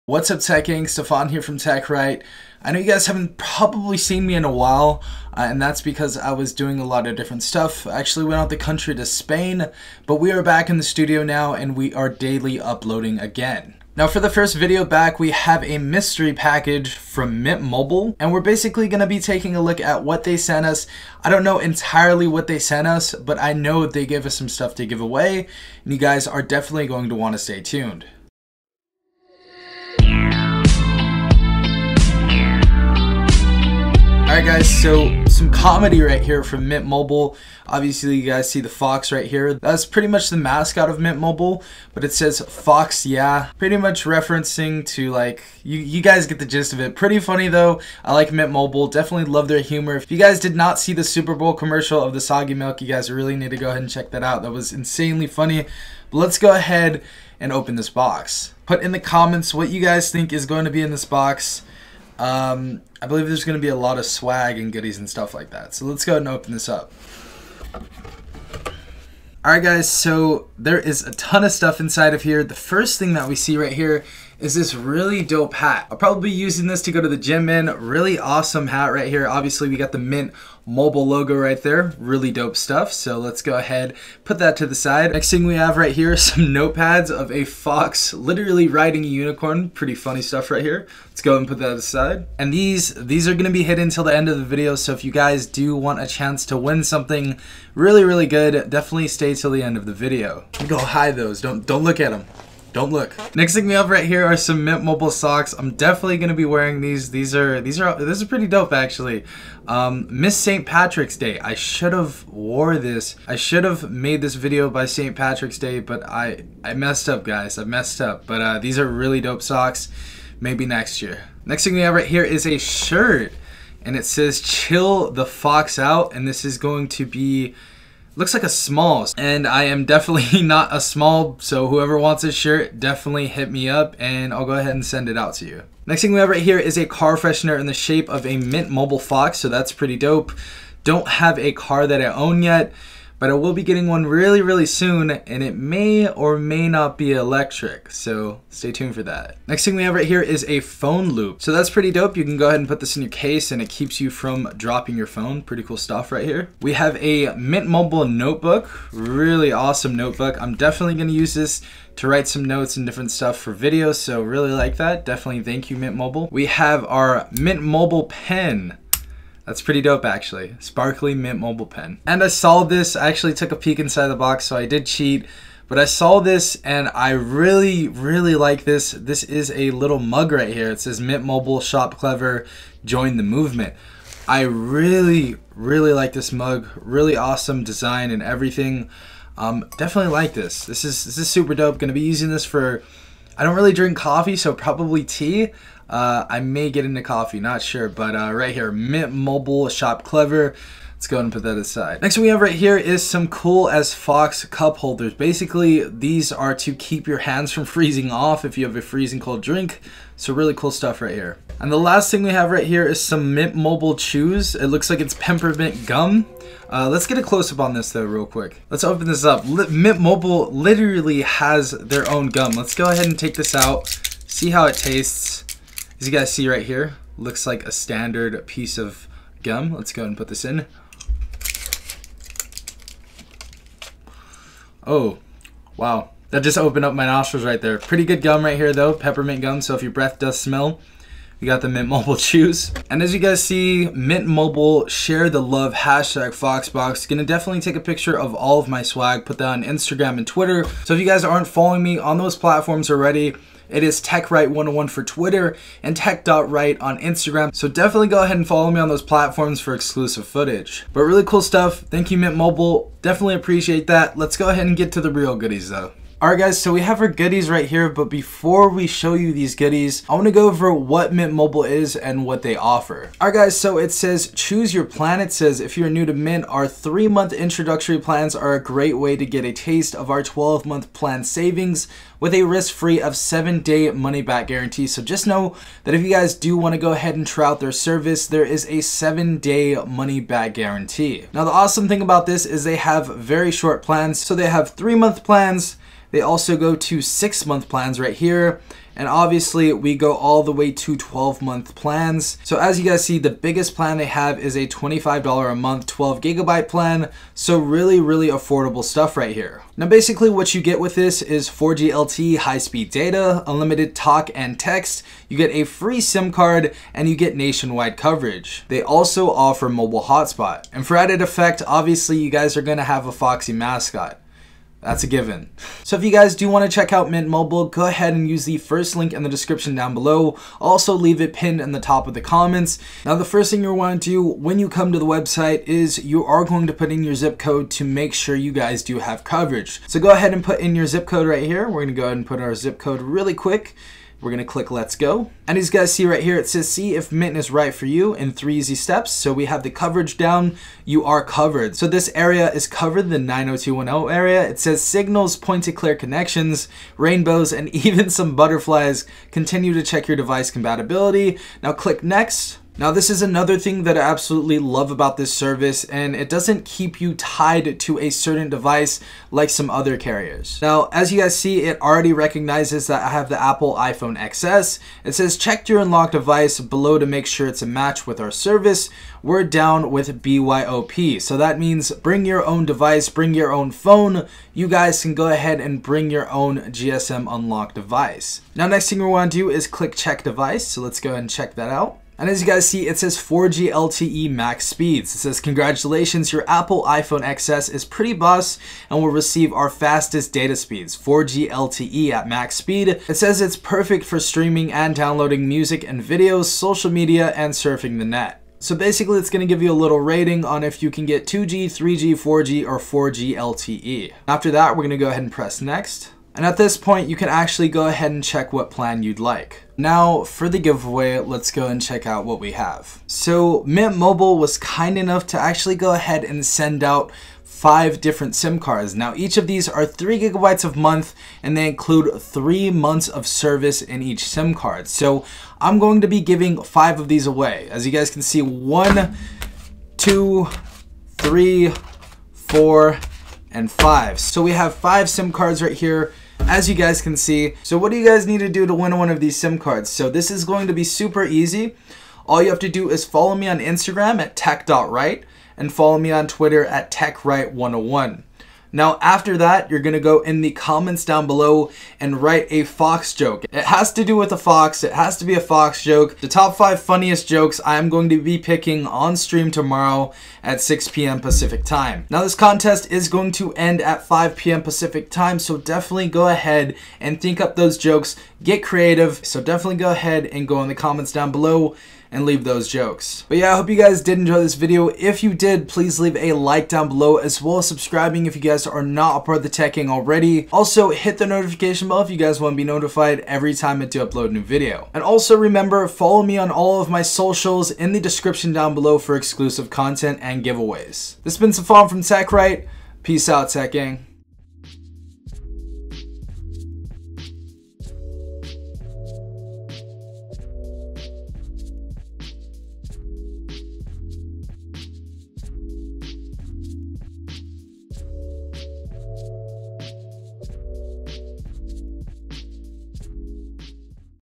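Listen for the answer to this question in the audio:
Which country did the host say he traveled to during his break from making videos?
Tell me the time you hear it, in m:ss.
0:09.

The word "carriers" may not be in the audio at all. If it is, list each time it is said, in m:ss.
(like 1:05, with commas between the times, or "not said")
6:09.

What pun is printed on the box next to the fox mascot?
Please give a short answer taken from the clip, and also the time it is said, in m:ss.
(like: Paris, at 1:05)
Fox Yeah, at 0:42.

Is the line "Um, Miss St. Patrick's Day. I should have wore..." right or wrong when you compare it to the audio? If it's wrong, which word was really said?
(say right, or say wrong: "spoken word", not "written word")
right.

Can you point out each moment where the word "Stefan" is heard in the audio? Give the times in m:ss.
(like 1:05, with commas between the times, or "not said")
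0:00, 8:21.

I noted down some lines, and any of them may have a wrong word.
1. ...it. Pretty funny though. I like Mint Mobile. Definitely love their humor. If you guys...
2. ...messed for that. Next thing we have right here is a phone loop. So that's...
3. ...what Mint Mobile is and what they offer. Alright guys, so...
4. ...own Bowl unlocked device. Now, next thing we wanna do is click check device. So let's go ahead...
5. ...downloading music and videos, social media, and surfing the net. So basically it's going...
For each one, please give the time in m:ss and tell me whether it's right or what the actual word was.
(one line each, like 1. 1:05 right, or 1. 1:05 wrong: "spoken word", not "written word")
1. 0:46 right
2. 2:28 wrong: "tuned", not "messed"
3. 4:30 right
4. 6:26 wrong: "GSM", not "Bowl"
5. 6:44 right.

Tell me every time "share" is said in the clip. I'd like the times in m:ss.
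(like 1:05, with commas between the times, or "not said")
4:04.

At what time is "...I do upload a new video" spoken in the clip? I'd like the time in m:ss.
8:13.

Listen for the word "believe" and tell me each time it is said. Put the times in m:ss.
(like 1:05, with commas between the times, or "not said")
1:03.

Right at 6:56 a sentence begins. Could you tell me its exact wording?
And at this point, you can actually go ahead and check what plan you'd like.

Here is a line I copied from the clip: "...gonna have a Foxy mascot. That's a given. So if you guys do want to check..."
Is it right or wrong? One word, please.
right.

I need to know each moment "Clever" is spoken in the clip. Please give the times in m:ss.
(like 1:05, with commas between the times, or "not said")
3:01, 3:20.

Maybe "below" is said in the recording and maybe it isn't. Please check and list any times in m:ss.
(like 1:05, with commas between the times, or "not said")
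5:29, 6:16, 7:41, 8:01, 8:06, 8:18.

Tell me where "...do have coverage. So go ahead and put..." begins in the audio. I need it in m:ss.
5:38.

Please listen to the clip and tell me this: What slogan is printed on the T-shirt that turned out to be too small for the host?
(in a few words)
Chill the Fox Out.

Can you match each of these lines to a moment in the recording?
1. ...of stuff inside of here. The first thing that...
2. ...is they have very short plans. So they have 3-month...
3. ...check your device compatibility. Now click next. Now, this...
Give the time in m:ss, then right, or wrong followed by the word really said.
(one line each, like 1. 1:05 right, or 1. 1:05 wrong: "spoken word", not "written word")
1. 1:11 right
2. 4:52 right
3. 5:59 right.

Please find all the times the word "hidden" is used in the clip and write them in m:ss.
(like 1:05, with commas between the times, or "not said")
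1:33.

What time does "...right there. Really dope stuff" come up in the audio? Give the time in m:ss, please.
1:21.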